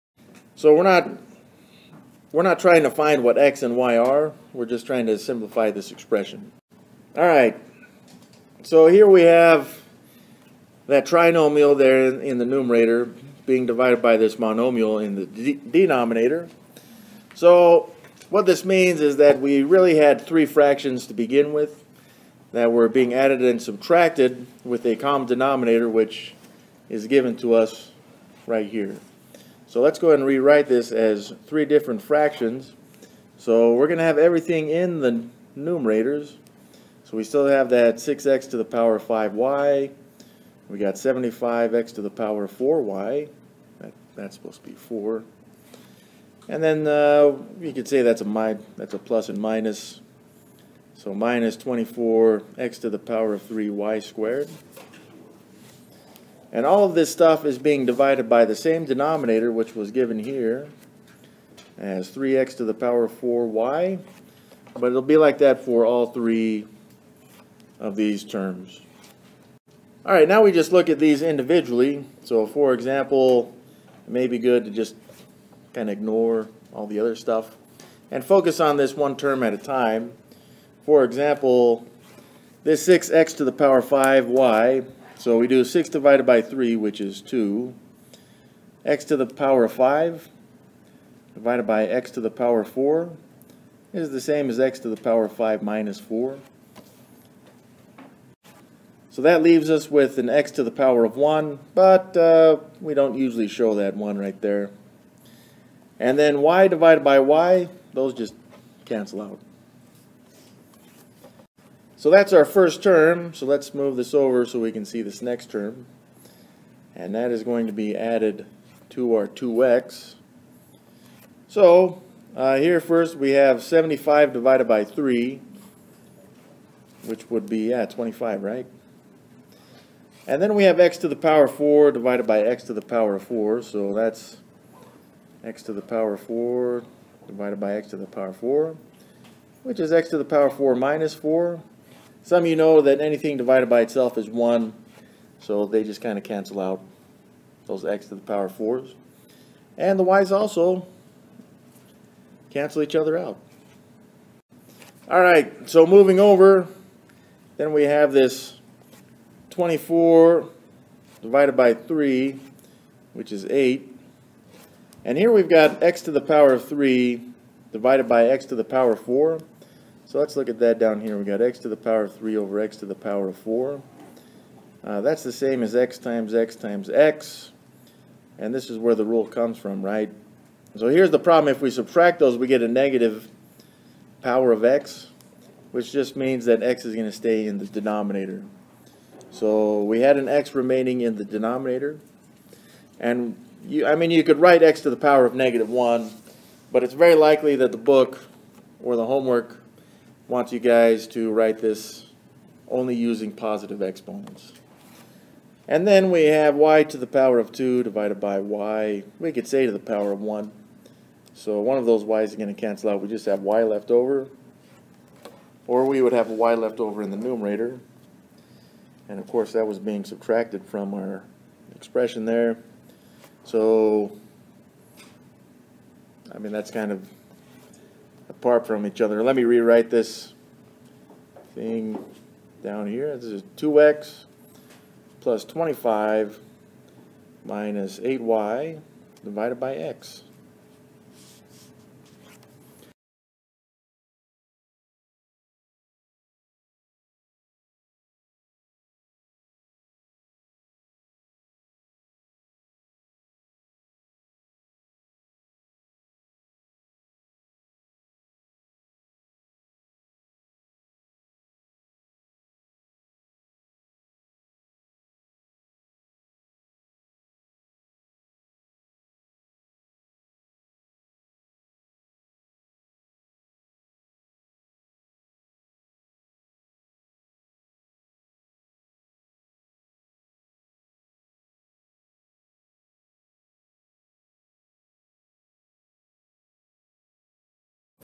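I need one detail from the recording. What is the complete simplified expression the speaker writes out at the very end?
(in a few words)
2x + 25 - 8y/x.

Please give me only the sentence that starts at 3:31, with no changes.
So one of those y's is going to cancel out.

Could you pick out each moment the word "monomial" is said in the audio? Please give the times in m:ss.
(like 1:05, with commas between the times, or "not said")
0:14.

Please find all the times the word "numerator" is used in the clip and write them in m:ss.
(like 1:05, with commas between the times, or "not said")
0:12, 0:35, 3:37.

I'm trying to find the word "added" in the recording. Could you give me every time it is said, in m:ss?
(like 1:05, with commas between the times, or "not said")
0:23, 1:57.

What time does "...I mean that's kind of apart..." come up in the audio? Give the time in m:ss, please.
3:46.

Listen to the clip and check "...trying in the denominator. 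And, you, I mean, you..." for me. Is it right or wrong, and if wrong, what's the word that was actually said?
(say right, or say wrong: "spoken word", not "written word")
wrong: "remaining", not "trying".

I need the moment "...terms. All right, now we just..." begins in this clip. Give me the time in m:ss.
1:08.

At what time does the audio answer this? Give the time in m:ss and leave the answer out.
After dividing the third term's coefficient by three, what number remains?
2:43.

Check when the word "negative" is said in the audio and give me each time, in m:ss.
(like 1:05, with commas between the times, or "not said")
3:02, 3:15.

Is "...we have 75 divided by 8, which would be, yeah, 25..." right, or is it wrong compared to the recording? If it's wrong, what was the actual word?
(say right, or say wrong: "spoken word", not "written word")
wrong: "3", not "8".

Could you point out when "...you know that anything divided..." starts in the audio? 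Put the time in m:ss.
2:22.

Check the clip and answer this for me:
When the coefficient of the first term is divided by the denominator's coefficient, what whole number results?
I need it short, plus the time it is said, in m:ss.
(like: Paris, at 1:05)
2, at 1:26.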